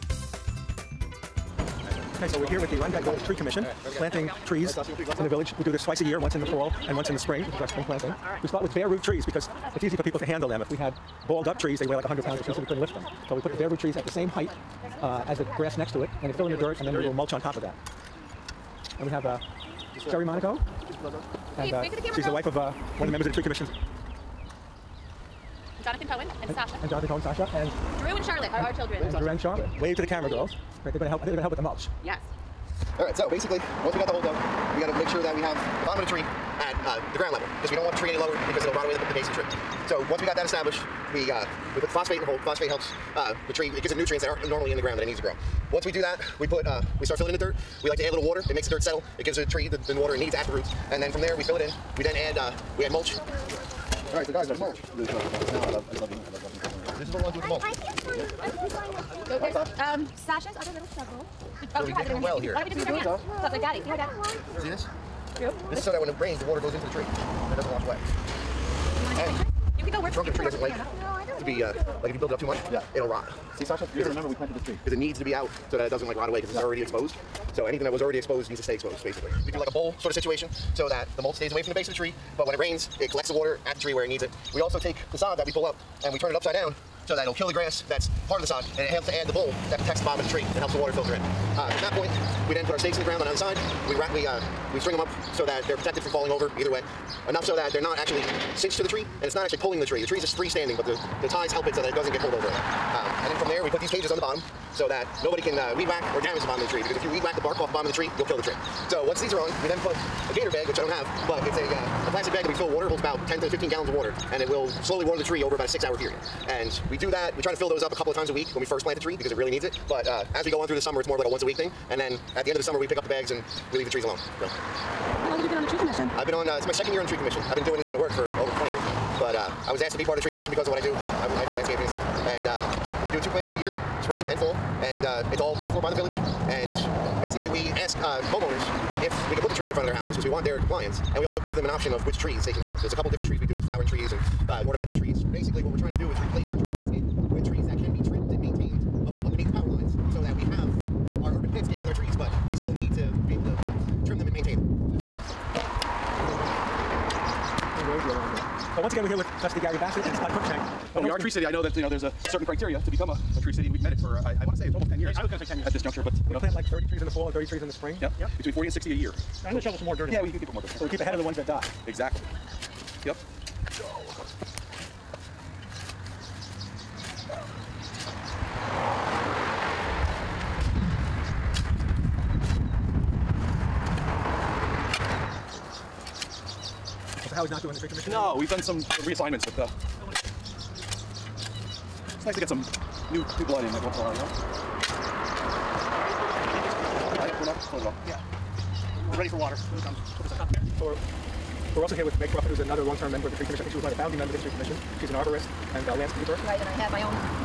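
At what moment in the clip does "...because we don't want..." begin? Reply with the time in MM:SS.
00:37.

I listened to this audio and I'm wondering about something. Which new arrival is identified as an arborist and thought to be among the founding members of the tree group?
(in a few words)
Meg Crawford.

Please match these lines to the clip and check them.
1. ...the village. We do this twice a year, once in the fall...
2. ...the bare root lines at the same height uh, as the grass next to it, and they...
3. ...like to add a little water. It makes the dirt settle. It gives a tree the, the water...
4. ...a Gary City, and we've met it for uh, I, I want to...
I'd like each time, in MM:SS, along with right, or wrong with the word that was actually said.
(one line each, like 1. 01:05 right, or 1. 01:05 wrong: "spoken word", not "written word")
1. 00:05 right
2. 00:13 wrong: "trees", not "lines"
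3. 00:47 right
4. 02:43 wrong: "Tree", not "Gary".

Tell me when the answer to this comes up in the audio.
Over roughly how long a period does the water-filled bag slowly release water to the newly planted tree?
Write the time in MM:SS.
01:55.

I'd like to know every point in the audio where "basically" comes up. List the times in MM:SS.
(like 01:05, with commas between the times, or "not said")
00:33, 01:19, 02:17, 02:25.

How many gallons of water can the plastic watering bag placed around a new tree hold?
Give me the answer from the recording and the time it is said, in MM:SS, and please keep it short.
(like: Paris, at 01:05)
10 to 15 gallons, at 01:53.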